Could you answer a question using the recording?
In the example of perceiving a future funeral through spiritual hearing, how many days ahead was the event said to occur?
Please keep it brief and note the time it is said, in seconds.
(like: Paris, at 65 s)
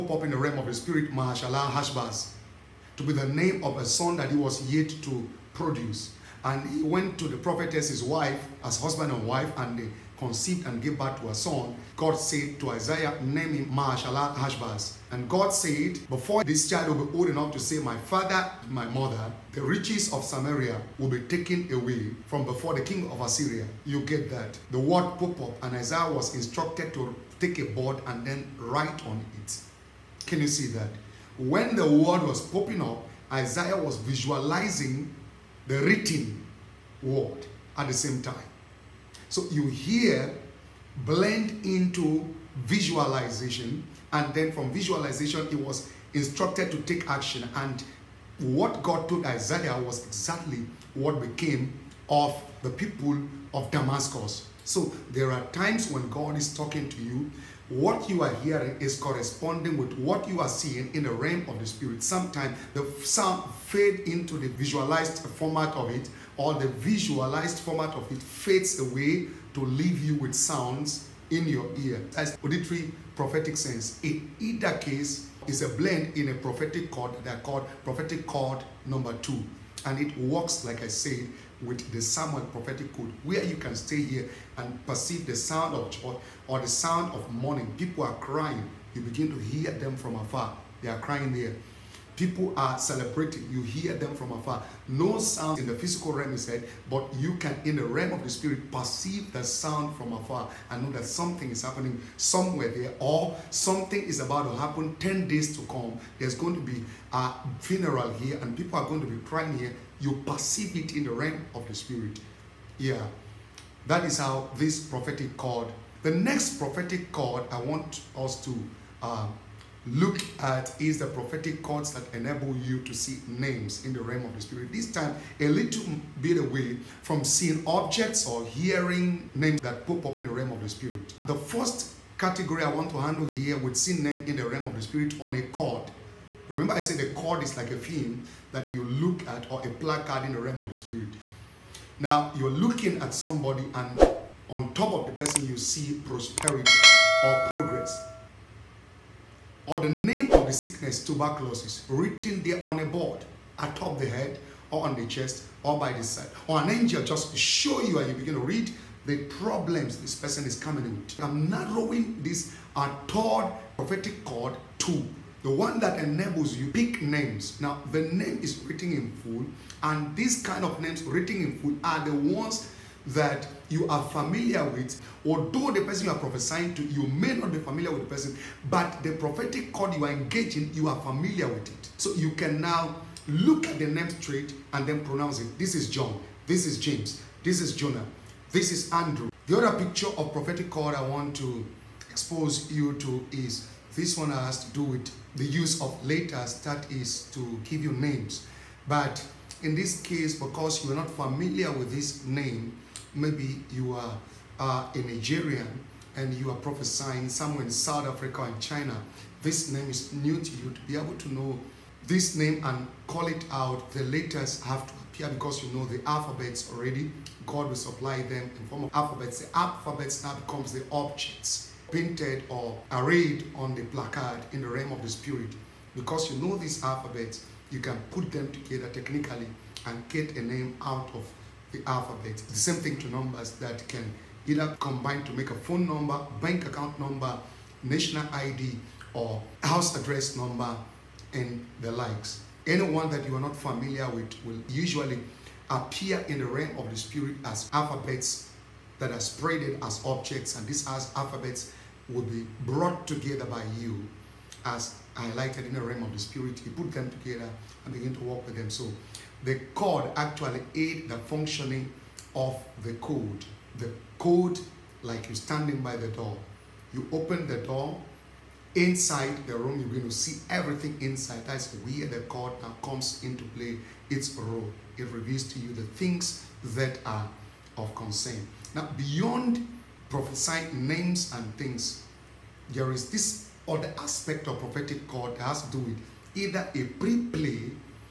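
10, at 104 s.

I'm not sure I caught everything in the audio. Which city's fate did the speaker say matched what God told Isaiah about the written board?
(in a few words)
Damascus.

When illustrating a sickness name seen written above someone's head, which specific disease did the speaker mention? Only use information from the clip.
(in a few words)
tuberculosis.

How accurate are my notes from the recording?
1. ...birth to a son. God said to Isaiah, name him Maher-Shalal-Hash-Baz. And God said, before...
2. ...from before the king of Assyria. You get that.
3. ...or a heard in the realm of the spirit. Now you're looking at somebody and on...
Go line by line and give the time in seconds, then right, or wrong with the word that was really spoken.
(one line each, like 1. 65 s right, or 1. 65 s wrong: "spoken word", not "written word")
1. 10 s right
2. 22 s right
3. 139 s wrong: "placard", not "heard".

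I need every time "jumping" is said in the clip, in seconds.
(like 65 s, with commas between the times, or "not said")
not said.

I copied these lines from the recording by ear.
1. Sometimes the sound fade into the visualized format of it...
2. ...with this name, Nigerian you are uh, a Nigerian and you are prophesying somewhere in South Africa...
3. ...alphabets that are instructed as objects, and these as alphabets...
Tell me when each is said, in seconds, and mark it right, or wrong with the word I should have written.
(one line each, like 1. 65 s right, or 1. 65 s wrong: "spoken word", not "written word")
1. 62 s right
2. 201 s wrong: "Maybe", not "Nigerian"
3. 247 s wrong: "spreaded", not "instructed".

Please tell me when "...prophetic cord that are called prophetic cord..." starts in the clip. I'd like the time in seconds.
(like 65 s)
76 s.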